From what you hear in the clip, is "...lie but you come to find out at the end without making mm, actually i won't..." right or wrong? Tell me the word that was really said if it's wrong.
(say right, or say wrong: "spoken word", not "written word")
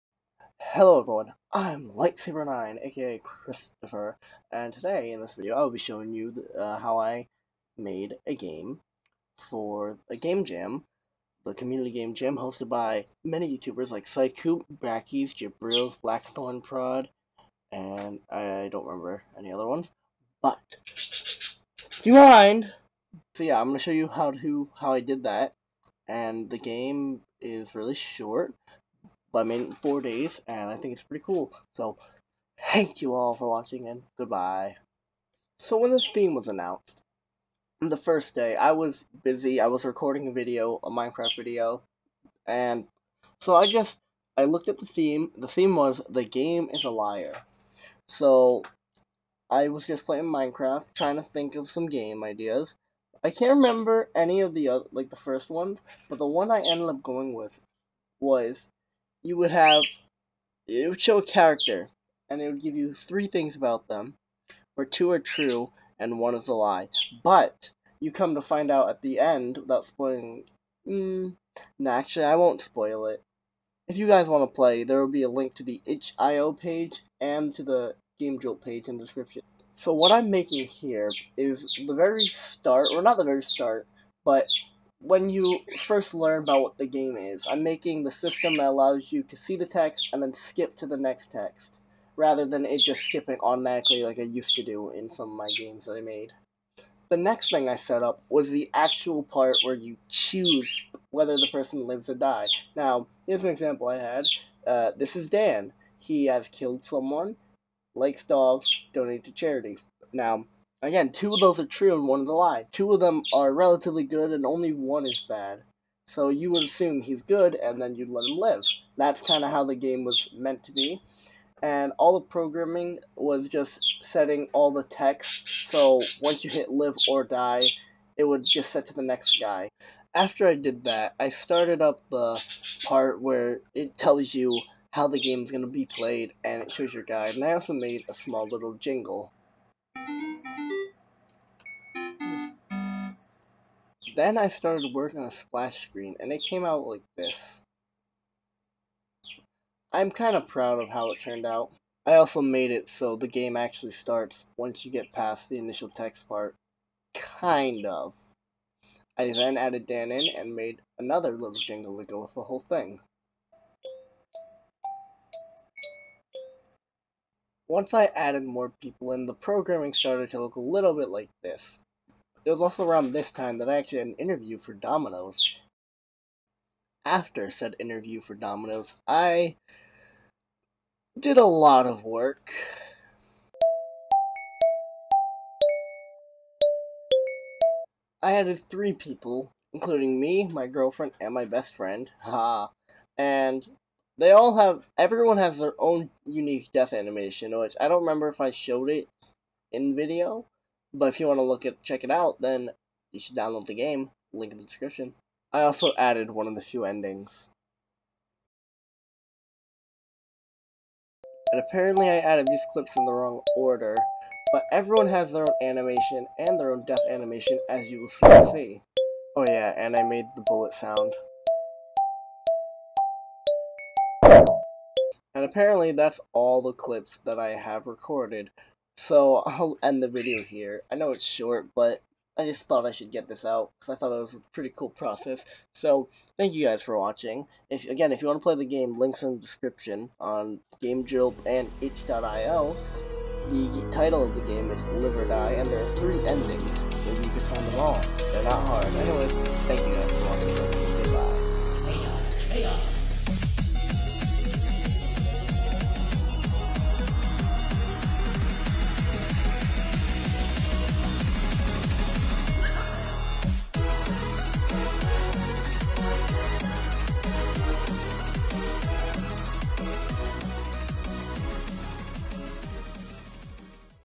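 wrong: "spoiling", not "making".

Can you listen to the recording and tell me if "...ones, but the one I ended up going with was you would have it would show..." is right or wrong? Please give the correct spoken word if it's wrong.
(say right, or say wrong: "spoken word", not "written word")
right.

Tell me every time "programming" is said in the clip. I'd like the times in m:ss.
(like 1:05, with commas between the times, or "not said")
2:02, 2:49.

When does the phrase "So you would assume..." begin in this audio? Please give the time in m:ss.
1:56.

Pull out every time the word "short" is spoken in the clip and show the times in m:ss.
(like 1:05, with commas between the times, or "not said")
0:27, 3:51.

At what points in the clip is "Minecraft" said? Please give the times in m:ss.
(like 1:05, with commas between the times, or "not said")
0:40, 0:50.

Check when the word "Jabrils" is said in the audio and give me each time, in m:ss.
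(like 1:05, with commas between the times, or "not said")
0:15.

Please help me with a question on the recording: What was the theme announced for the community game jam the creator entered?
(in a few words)
The game is a liar.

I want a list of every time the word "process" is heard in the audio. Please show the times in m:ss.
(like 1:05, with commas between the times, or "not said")
3:54.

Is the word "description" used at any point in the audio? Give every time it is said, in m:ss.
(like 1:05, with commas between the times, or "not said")
1:19, 3:24, 3:59.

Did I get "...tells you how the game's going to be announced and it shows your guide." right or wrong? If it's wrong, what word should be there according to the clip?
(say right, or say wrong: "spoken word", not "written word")
wrong: "played", not "announced".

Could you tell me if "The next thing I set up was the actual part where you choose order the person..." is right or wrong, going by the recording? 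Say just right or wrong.
wrong.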